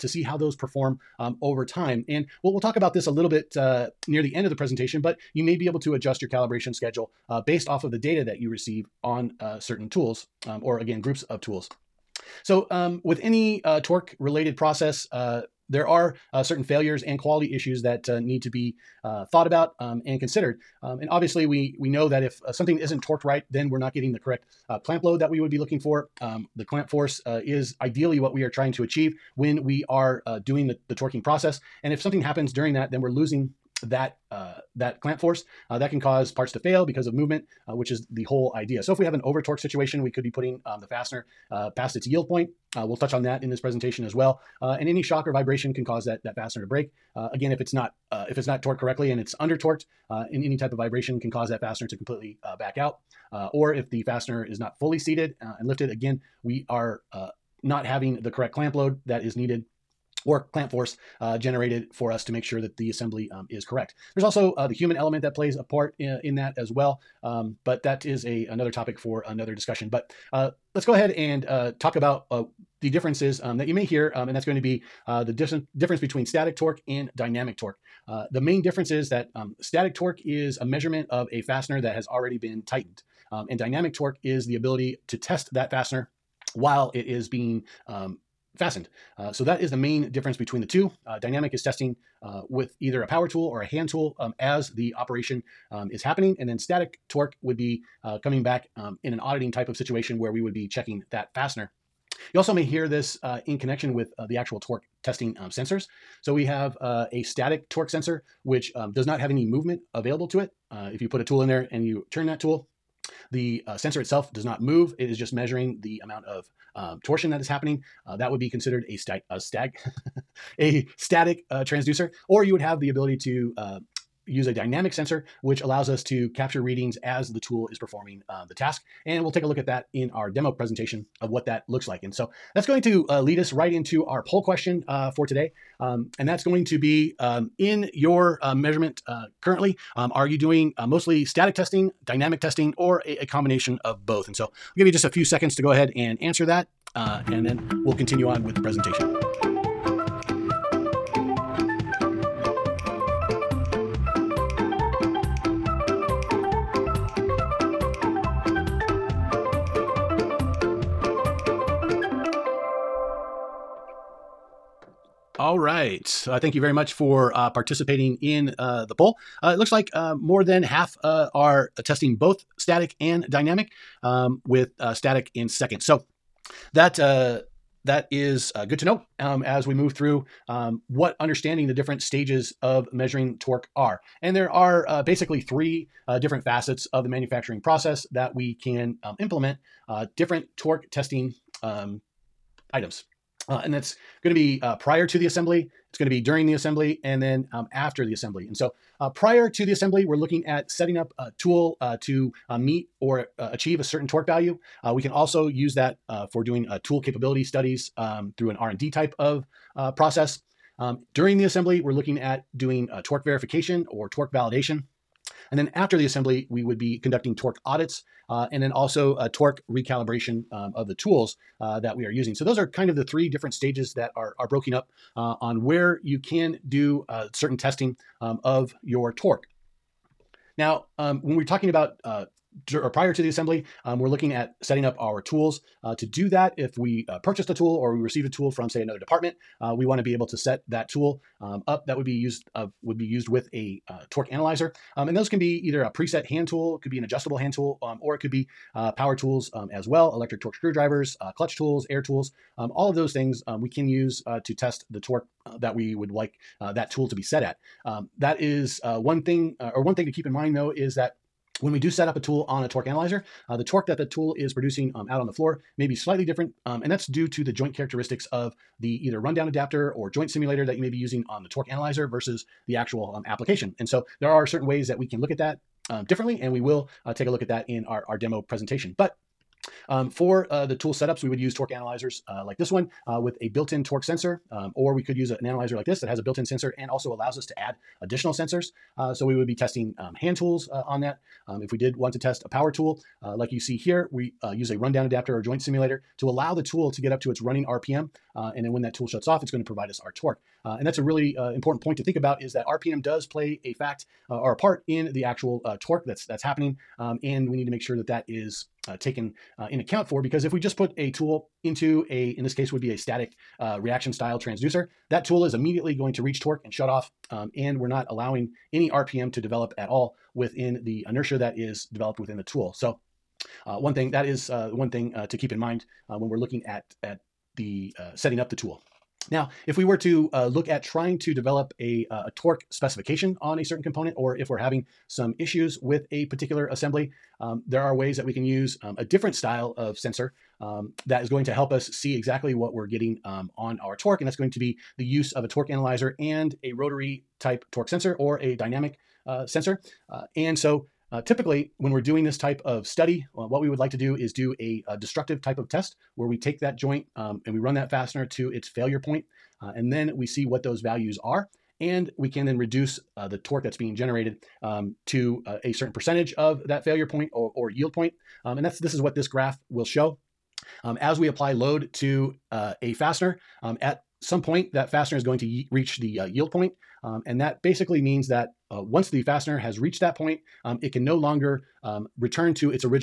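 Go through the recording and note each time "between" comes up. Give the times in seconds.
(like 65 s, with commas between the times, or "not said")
75 s, 90 s.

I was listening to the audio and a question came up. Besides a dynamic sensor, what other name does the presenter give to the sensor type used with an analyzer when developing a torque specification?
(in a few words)
Rotary type torque sensor.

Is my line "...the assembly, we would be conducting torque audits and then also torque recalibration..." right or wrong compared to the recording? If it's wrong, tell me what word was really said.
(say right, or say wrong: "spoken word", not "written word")
right.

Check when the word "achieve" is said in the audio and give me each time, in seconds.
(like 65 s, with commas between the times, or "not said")
28 s, 203 s.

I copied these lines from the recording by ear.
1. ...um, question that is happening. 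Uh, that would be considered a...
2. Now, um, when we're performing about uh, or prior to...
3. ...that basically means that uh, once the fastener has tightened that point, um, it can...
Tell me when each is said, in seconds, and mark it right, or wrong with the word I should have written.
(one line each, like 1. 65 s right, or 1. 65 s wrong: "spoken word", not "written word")
1. 116 s wrong: "torsion", not "question"
2. 230 s wrong: "talking", not "performing"
3. 377 s wrong: "reached", not "tightened".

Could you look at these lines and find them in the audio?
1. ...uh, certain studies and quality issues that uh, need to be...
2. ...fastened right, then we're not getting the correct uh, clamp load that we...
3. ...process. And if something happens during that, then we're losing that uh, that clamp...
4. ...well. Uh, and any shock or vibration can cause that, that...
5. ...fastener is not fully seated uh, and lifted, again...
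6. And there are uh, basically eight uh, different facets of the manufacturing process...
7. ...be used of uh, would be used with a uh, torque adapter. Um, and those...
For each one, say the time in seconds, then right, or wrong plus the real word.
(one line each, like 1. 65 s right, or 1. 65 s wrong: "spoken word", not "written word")
1. 16 s wrong: "failures", not "studies"
2. 23 s wrong: "torqued", not "fastened"
3. 31 s right
4. 44 s right
5. 54 s right
6. 184 s wrong: "three", not "eight"
7. 242 s wrong: "analyzer", not "adapter".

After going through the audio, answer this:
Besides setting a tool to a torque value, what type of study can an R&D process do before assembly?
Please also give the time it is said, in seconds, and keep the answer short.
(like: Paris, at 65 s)
Tool capability studies, at 206 s.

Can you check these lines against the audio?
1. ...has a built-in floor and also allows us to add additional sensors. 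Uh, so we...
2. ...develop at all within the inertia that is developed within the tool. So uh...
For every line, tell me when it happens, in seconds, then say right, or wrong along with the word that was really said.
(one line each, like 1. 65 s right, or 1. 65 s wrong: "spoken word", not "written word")
1. 286 s wrong: "sensor", not "floor"
2. 319 s right.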